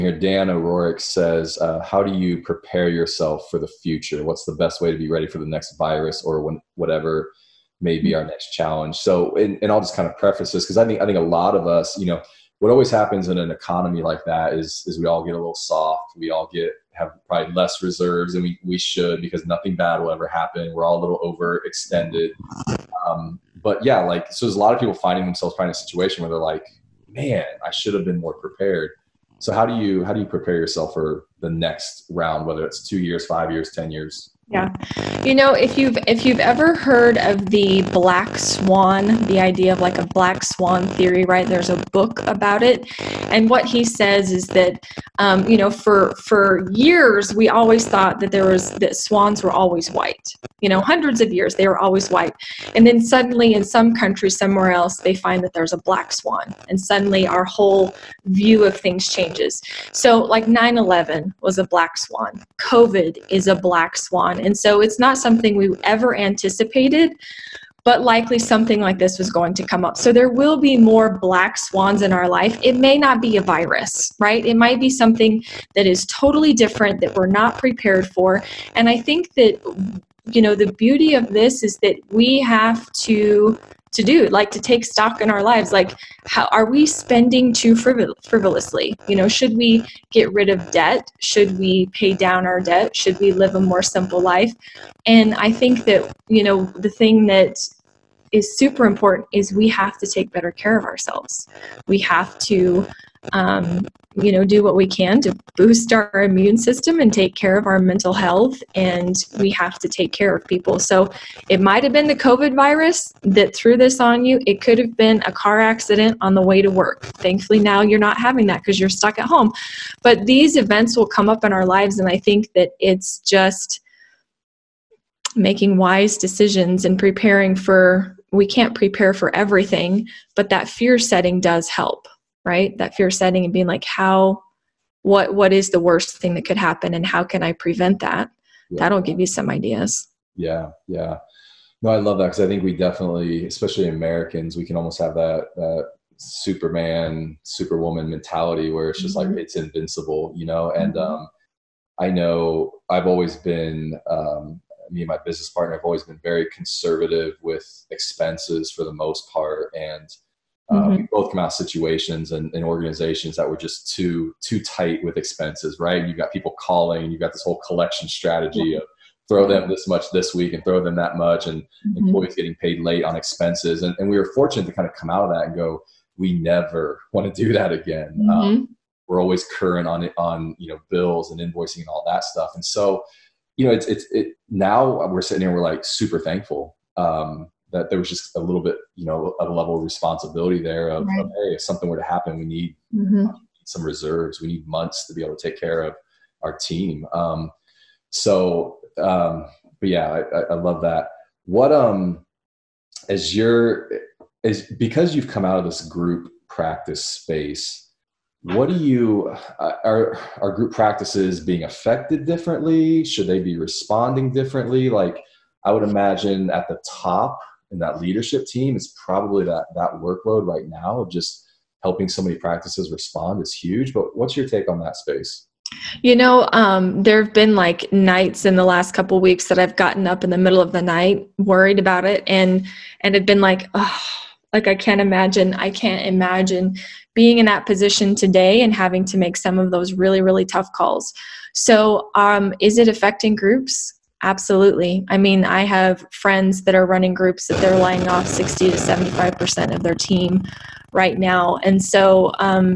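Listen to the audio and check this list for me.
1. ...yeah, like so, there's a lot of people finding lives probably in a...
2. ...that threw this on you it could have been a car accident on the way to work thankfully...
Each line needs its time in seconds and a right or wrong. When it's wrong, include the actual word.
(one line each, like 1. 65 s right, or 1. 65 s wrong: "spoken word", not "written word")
1. 23 s wrong: "themselves", not "lives"
2. 113 s right.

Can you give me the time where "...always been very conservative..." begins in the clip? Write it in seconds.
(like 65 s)
155 s.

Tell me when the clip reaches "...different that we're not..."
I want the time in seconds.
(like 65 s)
76 s.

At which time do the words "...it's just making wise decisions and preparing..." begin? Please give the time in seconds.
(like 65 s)
122 s.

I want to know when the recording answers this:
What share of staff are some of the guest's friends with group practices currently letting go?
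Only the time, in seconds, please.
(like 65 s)
248 s.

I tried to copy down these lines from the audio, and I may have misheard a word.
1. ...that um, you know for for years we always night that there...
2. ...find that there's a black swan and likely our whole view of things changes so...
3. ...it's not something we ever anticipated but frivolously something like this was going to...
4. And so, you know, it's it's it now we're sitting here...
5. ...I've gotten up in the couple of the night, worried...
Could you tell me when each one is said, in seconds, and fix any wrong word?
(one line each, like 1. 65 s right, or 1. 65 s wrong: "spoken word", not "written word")
1. 44 s wrong: "thought", not "night"
2. 55 s wrong: "suddenly", not "likely"
3. 64 s wrong: "likely", not "frivolously"
4. 182 s right
5. 229 s wrong: "middle", not "couple".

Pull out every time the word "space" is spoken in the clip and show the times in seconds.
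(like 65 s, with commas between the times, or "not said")
207 s, 224 s.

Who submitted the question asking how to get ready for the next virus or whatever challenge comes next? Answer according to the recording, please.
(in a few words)
Dan O'Rourke.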